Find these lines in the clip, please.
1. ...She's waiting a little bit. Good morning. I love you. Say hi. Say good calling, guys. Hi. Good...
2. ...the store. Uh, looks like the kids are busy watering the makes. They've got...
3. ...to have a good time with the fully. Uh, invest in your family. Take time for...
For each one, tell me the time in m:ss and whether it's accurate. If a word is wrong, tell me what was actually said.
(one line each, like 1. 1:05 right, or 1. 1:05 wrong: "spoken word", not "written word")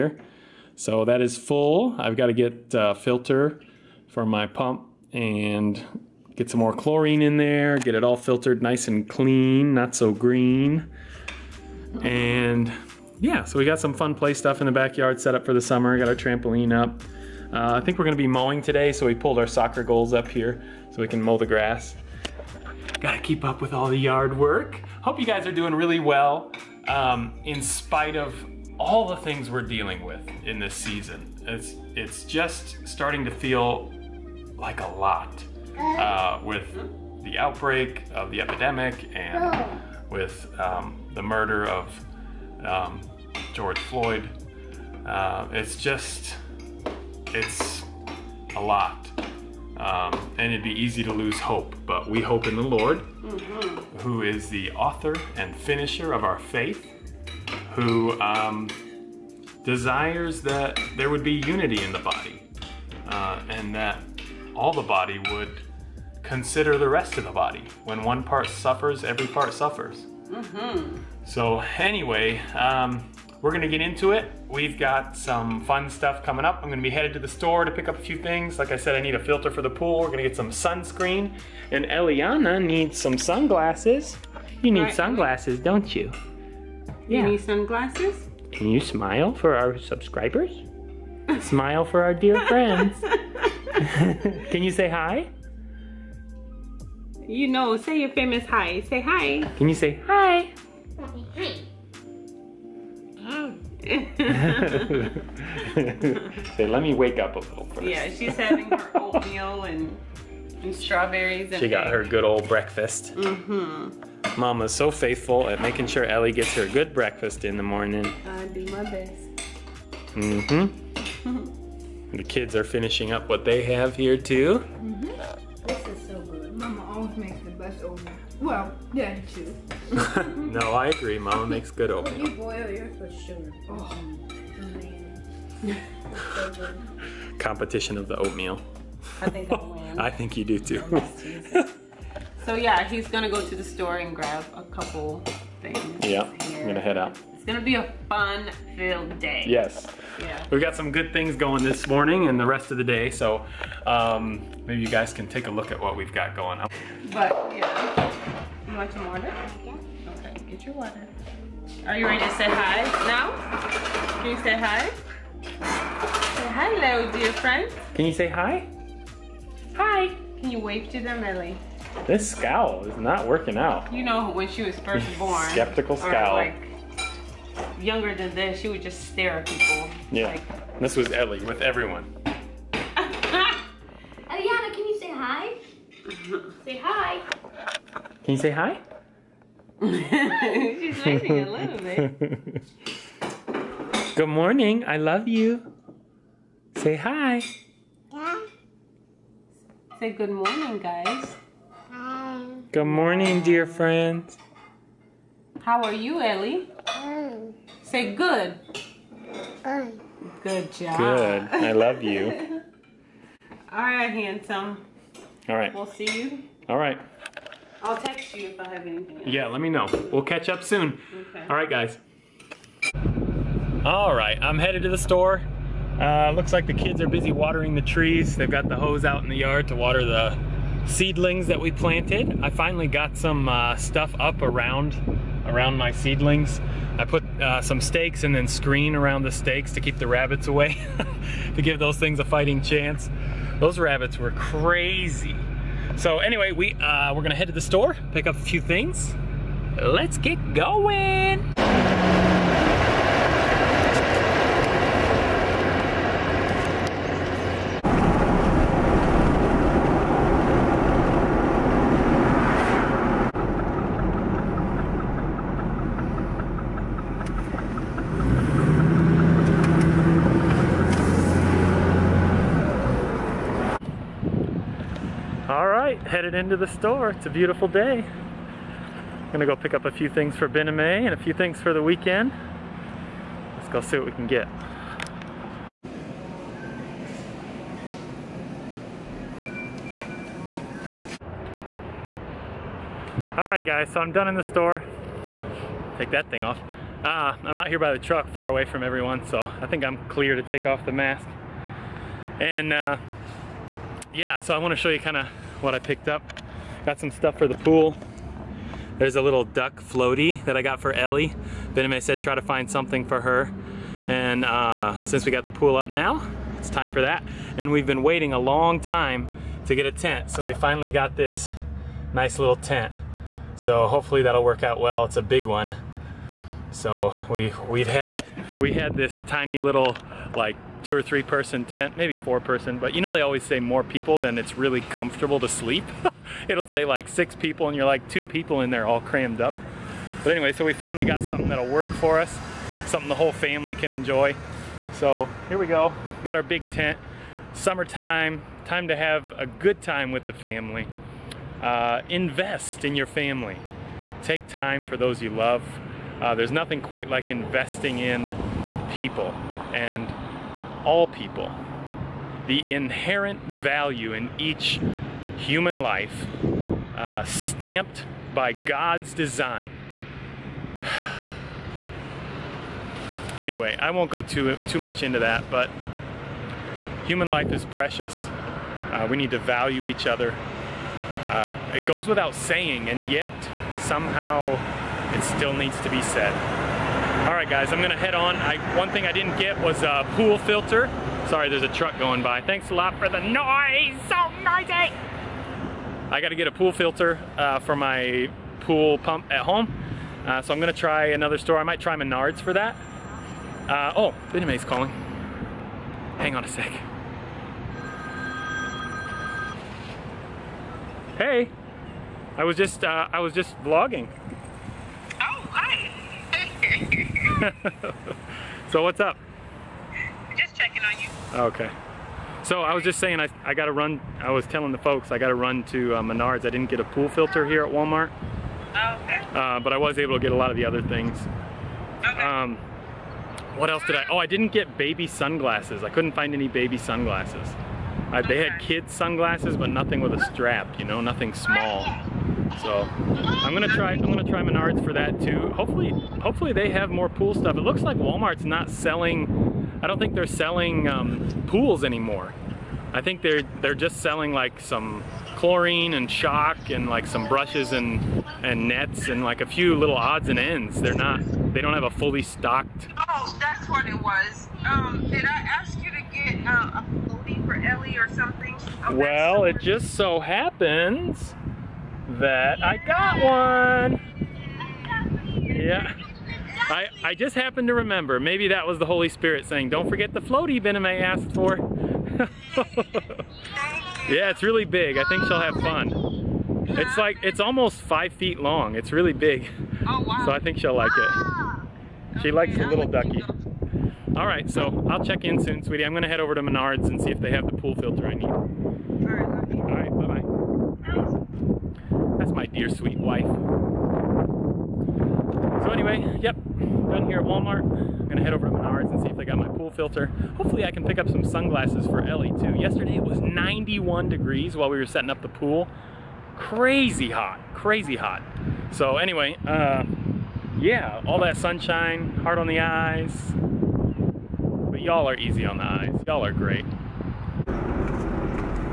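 1. 3:09 wrong: "morning", not "calling"
2. 3:44 wrong: "trees", not "makes"
3. 5:48 wrong: "family", not "fully".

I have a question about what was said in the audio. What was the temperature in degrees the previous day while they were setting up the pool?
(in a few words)
91.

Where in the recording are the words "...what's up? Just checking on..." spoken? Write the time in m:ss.
6:58.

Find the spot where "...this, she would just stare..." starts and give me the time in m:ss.
2:58.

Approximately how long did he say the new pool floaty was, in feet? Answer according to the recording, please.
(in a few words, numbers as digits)
5 feet.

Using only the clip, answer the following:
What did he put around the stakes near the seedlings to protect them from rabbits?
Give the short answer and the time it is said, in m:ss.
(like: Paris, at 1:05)
Screen, at 3:58.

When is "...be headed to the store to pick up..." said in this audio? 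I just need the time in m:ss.
1:16.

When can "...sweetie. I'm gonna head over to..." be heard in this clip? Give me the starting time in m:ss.
8:15.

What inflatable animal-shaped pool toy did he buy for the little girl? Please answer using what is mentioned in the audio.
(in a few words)
Duck floaty.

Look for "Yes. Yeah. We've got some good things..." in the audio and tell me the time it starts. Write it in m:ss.
2:29.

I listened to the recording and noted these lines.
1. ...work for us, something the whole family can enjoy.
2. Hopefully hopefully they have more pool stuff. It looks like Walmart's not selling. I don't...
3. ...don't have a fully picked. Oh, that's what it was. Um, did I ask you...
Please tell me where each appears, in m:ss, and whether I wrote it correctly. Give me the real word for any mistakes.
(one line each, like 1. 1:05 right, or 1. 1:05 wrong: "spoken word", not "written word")
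1. 5:41 right
2. 7:25 right
3. 7:41 wrong: "stocked", not "picked".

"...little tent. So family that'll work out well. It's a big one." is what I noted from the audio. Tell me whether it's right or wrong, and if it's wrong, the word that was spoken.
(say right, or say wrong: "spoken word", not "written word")
wrong: "hopefully", not "family".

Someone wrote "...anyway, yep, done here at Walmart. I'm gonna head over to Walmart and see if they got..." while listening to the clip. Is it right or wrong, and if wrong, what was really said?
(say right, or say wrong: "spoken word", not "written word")
wrong: "Menards", not "Walmart".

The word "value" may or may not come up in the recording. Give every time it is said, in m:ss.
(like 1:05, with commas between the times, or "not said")
6:03, 6:19.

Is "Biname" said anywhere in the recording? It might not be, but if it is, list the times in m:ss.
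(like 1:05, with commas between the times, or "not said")
5:11, 6:44.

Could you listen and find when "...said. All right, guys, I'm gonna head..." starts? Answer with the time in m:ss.
6:26.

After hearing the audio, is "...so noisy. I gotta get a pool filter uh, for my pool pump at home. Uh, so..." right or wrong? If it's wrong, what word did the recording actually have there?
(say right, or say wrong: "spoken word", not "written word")
right.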